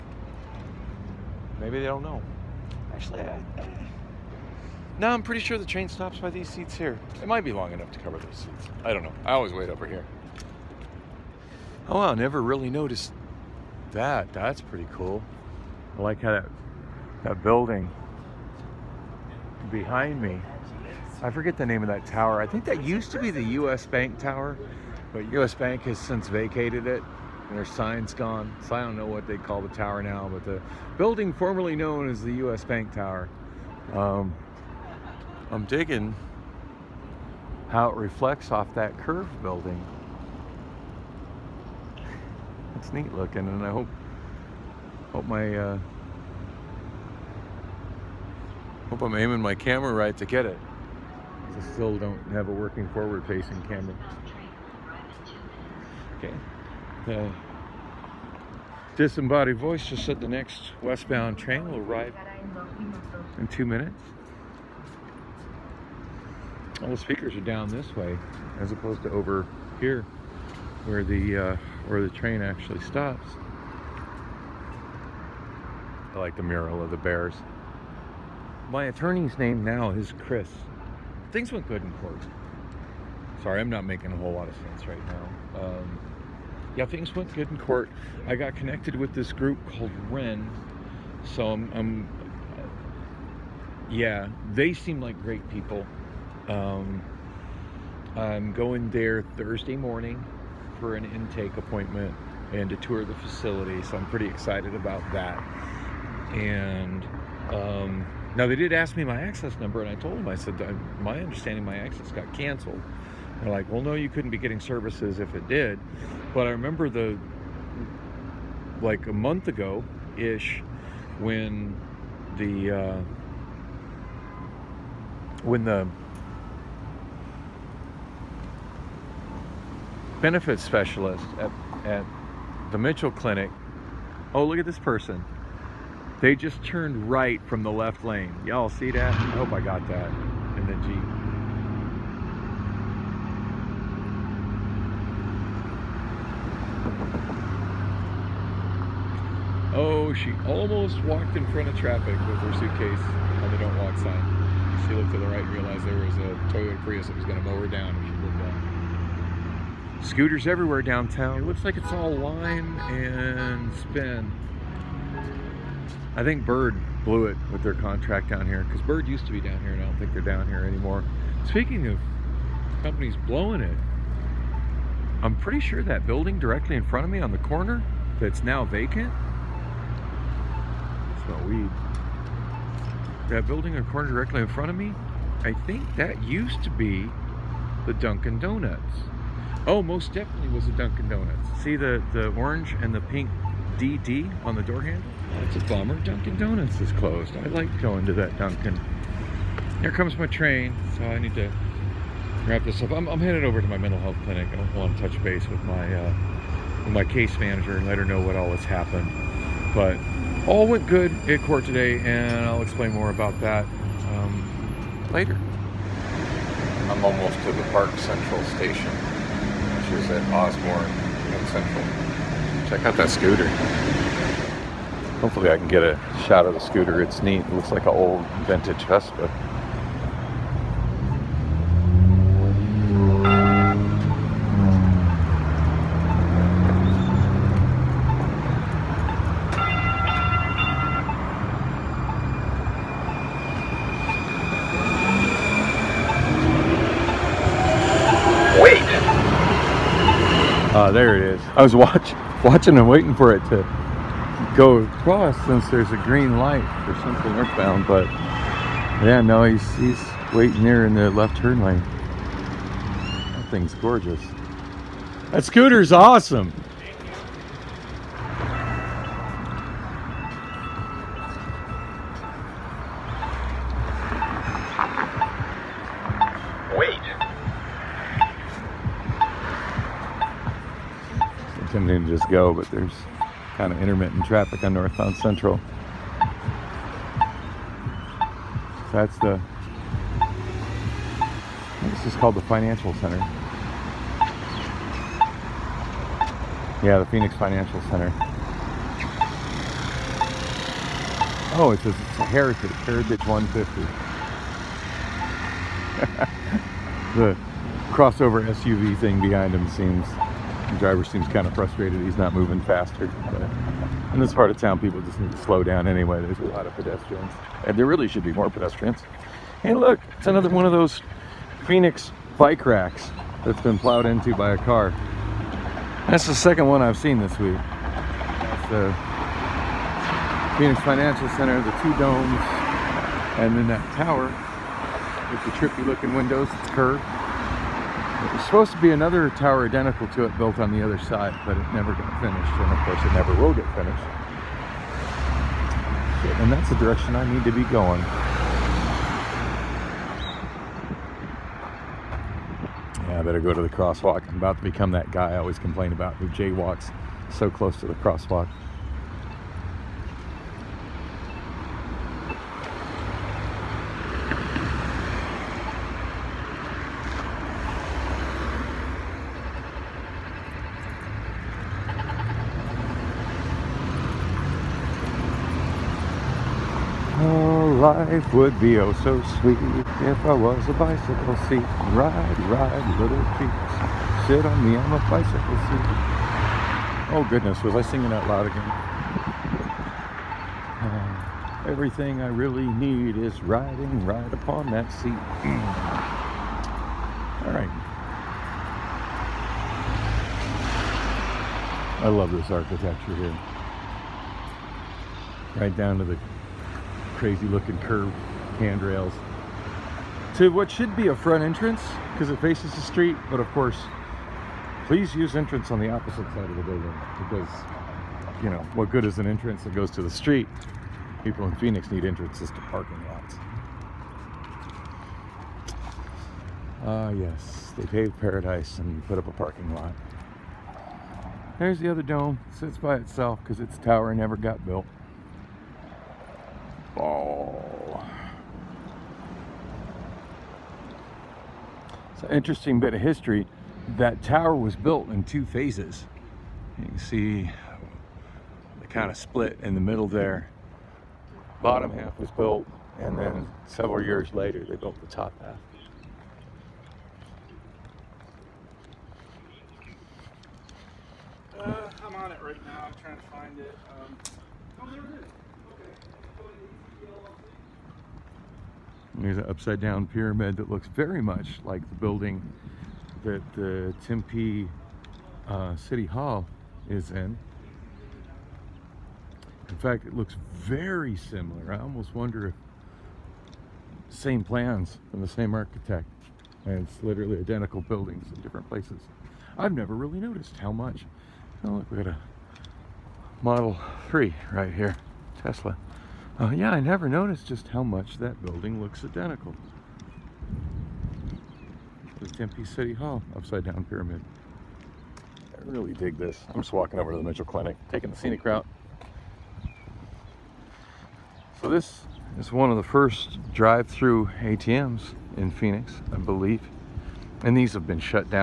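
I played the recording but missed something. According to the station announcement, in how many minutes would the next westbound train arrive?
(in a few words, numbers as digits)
2.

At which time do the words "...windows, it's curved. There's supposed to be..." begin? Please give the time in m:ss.
5:36.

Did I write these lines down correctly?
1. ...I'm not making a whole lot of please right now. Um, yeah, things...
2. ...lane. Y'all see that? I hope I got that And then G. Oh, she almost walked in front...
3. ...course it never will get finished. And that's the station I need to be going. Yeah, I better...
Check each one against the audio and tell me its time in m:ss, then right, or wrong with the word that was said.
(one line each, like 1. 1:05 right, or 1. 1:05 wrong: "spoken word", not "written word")
1. 1:23 wrong: "sense", not "please"
2. 2:18 right
3. 5:42 wrong: "direction", not "station".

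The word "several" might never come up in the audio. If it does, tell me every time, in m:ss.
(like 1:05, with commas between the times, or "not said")
7:33.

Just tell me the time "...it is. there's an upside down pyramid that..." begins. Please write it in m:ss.
7:44.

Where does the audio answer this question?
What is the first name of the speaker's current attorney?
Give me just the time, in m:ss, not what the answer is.
1:20.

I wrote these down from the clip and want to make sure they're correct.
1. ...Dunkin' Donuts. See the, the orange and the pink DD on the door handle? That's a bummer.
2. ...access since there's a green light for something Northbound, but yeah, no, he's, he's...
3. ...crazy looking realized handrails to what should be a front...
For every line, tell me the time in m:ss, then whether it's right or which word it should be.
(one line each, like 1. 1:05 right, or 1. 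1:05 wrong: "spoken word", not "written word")
1. 3:10 right
2. 4:14 wrong: "across", not "access"
3. 6:47 wrong: "curved", not "realized".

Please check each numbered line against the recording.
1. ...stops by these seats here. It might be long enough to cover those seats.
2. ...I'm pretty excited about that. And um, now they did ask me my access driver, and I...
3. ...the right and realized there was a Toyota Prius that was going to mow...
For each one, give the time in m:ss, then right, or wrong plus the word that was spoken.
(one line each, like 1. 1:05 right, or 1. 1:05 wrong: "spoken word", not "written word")
1. 0:05 right
2. 1:43 wrong: "number", not "driver"
3. 2:35 right.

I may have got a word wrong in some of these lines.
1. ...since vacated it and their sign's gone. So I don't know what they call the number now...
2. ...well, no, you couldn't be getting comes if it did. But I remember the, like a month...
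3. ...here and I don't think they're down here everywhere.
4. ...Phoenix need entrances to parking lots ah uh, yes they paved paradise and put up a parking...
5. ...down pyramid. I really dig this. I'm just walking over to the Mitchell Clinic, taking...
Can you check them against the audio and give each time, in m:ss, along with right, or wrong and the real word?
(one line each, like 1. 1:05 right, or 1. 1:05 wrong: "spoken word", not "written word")
1. 0:25 wrong: "tower", not "number"
2. 1:53 wrong: "services", not "comes"
3. 2:49 wrong: "anymore", not "everywhere"
4. 7:01 right
5. 8:23 right.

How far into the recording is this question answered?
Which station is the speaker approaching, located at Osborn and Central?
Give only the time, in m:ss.
3:37.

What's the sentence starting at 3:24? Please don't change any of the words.
I want to touch base with my, uh, with my case manager and let her know what all has happened.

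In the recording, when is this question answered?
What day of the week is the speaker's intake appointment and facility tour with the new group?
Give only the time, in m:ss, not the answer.
1:39.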